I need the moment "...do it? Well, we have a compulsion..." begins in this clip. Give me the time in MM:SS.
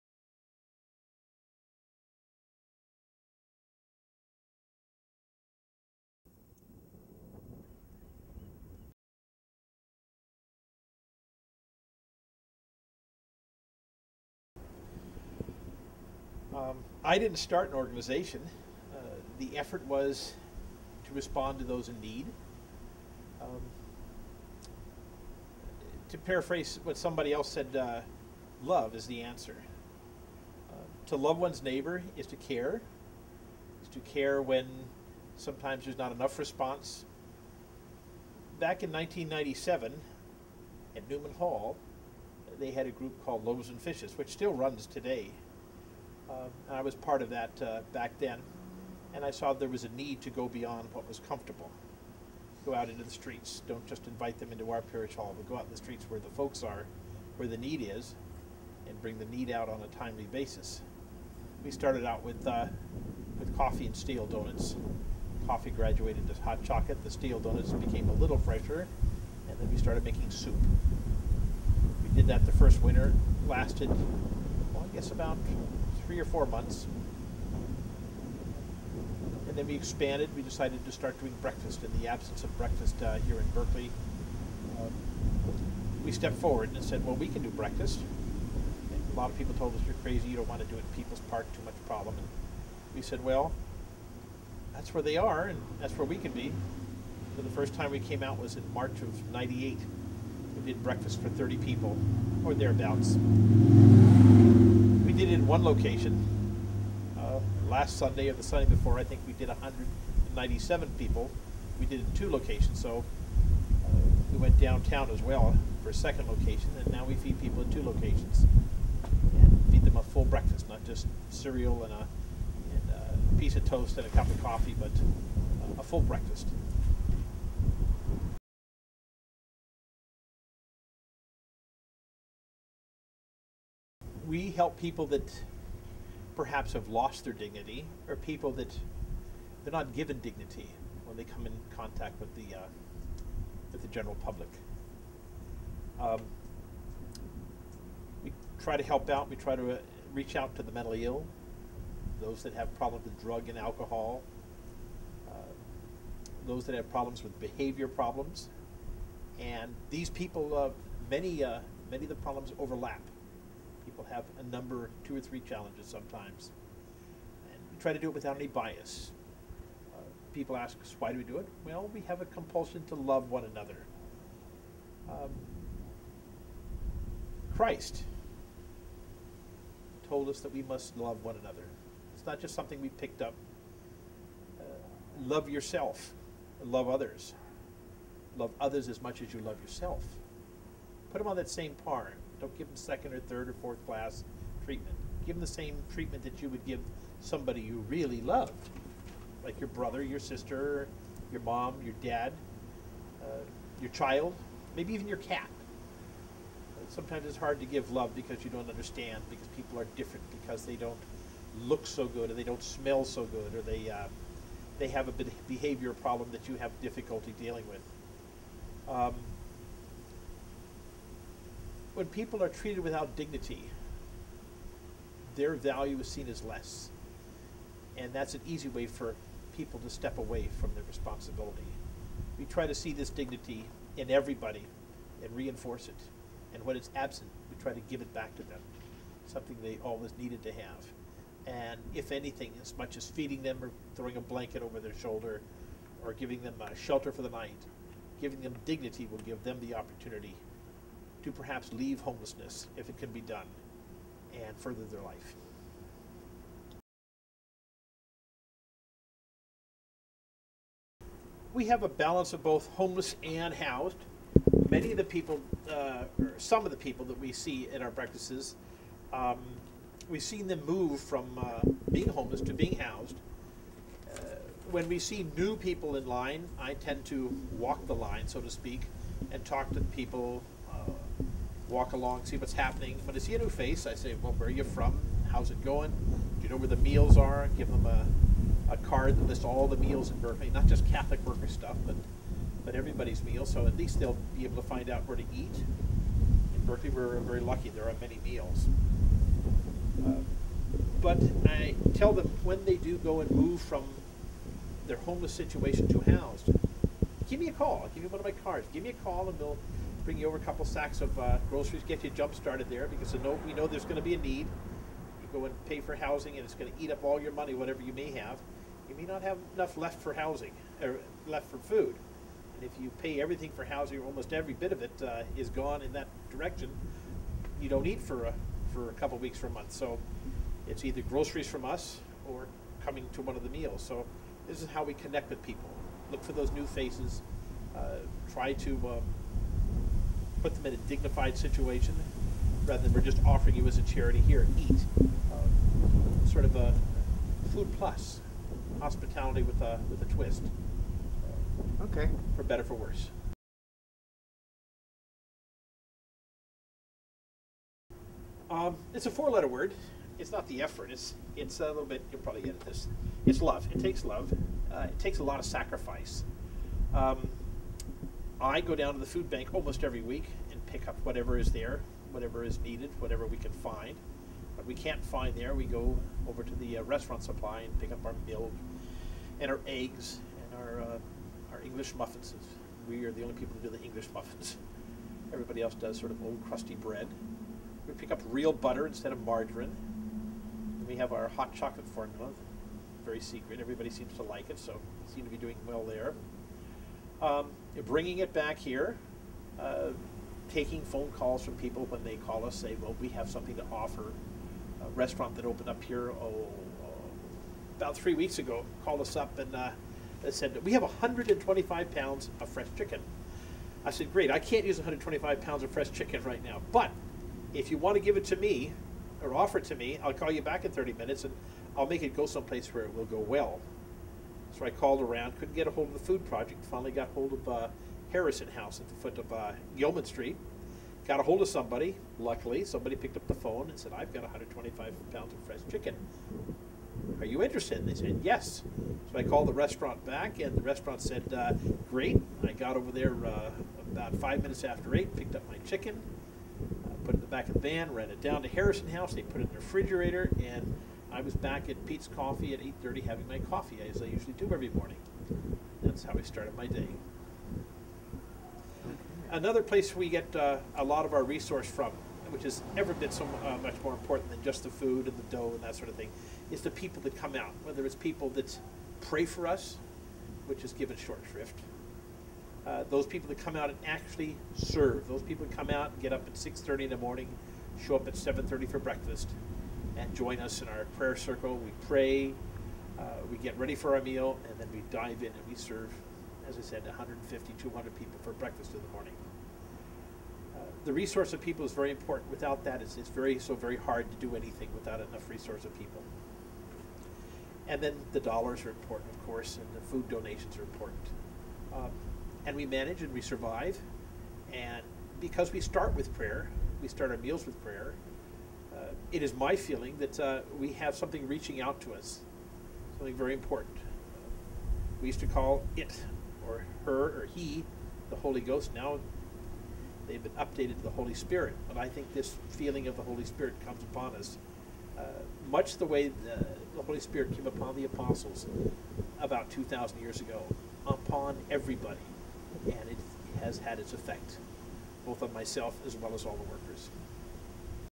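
02:51.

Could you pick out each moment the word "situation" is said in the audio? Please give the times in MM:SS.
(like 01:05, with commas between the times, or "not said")
05:05, 05:41.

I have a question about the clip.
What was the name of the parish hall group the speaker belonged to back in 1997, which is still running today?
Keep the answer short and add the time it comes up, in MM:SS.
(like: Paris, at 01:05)
Loaves and Fishes, at 00:43.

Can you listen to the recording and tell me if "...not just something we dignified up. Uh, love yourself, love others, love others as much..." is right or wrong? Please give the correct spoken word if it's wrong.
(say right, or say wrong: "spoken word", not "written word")
wrong: "picked", not "dignified".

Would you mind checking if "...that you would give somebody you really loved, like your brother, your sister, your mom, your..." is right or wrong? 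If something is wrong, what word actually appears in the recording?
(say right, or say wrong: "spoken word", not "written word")
right.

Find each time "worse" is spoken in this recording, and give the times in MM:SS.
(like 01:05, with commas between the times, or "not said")
05:52.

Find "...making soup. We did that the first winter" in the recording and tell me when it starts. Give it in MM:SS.
01:10.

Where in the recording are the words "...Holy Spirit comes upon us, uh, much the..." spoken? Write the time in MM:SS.
08:43.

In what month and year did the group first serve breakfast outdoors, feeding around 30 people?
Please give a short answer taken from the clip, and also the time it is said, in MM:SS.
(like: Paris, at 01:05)
March 1998, at 01:38.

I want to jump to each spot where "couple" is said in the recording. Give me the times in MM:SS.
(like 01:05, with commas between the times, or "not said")
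05:10, 05:28.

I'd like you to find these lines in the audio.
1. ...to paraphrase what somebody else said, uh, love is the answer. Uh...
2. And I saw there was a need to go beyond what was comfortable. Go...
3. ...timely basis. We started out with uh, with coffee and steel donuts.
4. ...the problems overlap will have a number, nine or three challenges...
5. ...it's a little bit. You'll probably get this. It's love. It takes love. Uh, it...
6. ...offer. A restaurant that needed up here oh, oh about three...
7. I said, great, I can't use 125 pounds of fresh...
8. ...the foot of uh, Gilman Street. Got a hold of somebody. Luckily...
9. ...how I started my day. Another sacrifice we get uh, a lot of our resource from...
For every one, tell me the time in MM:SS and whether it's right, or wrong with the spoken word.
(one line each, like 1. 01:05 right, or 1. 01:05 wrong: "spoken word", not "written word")
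1. 00:26 right
2. 00:49 right
3. 00:59 right
4. 02:42 wrong: "two", not "nine"
5. 06:01 right
6. 06:43 wrong: "opened", not "needed"
7. 06:53 right
8. 07:08 right
9. 07:36 wrong: "place", not "sacrifice".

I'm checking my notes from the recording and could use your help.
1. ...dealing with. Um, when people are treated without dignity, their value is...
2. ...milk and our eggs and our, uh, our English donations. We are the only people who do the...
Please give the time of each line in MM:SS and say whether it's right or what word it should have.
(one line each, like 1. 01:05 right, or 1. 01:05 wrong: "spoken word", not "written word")
1. 03:37 right
2. 06:18 wrong: "muffins", not "donations".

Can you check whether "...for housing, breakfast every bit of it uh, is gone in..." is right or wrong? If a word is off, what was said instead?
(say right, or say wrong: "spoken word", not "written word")
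wrong: "almost", not "breakfast".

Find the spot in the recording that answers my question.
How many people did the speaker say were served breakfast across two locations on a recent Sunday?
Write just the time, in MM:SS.
01:49.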